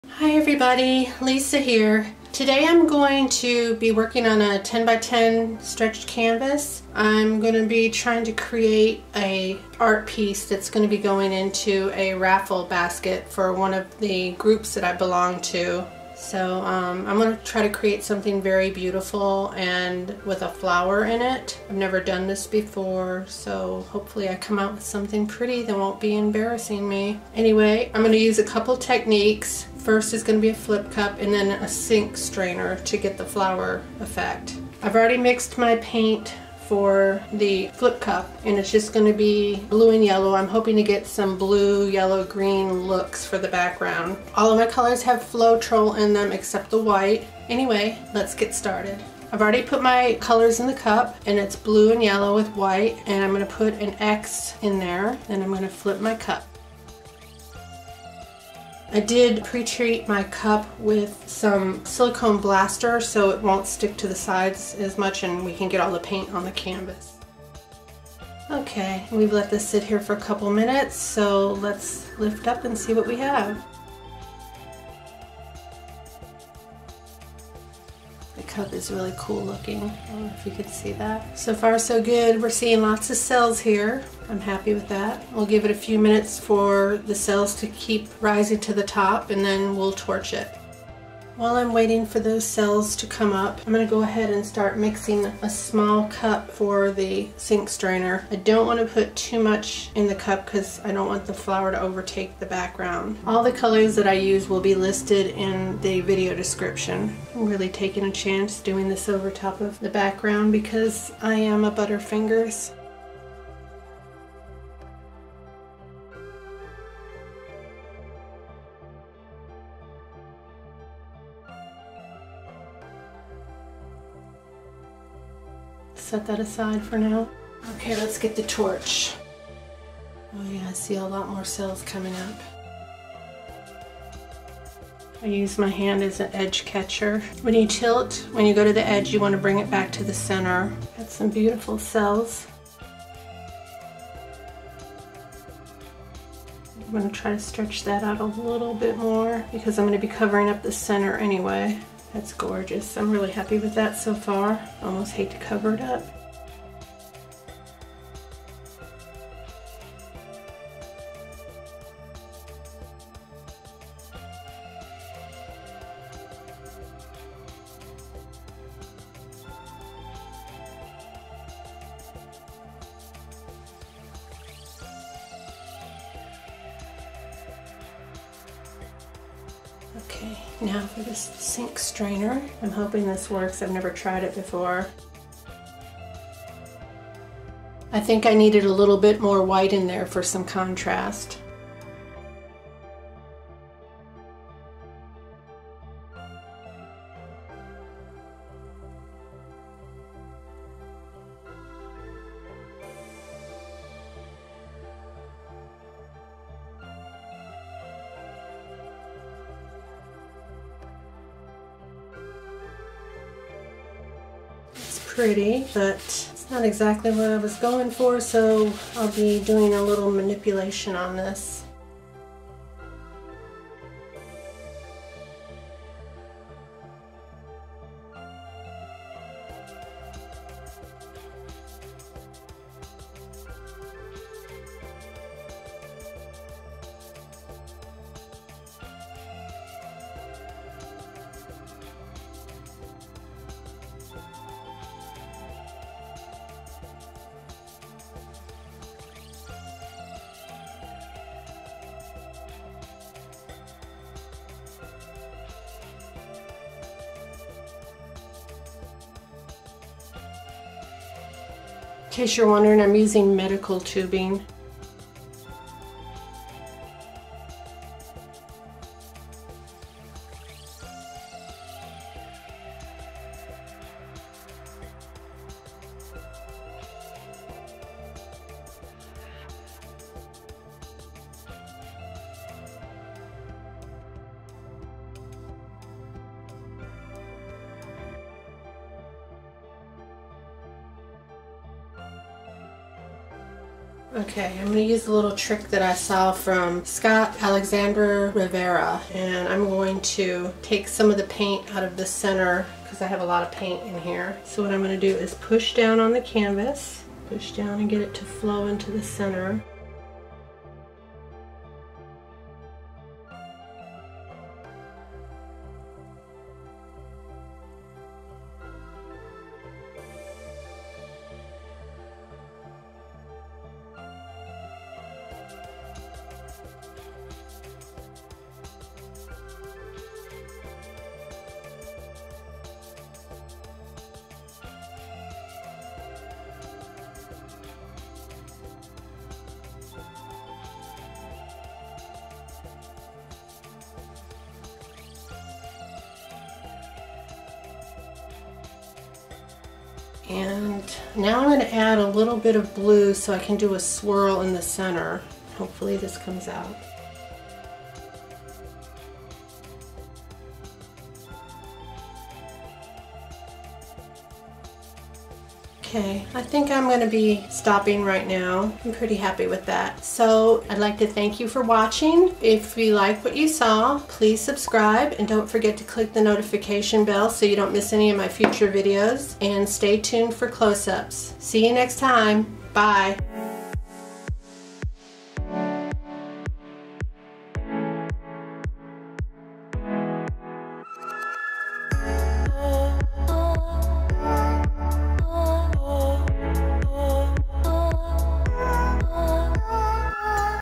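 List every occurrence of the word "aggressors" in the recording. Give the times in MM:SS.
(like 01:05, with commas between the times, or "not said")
not said.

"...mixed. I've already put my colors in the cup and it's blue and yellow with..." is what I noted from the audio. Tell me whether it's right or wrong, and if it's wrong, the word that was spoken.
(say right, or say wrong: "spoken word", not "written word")
wrong: "started", not "mixed".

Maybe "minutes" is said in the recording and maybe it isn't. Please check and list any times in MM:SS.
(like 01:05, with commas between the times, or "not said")
01:10, 01:25.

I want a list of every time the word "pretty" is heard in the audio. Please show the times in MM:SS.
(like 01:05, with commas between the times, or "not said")
00:25, 03:35, 06:08.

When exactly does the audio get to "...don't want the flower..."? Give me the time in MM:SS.
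01:40.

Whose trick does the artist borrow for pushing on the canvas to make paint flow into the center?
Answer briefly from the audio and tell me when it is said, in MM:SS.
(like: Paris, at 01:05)
Scott Alexander Rivera, at 04:56.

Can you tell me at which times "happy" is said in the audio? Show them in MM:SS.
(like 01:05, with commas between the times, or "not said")
01:24, 02:33, 06:09.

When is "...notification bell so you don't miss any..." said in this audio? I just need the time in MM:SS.
06:16.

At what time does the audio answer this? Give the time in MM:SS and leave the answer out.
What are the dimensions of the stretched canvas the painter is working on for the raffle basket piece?
00:04.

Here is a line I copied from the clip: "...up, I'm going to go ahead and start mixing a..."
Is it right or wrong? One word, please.
right.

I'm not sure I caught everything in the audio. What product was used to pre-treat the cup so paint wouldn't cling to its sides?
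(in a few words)
silicone blaster.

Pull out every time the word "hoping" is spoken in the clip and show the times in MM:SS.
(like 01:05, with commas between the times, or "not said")
00:40, 03:02.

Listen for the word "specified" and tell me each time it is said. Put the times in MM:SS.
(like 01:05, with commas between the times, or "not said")
not said.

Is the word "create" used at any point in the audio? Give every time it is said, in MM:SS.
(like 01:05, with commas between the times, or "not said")
00:08, 00:17.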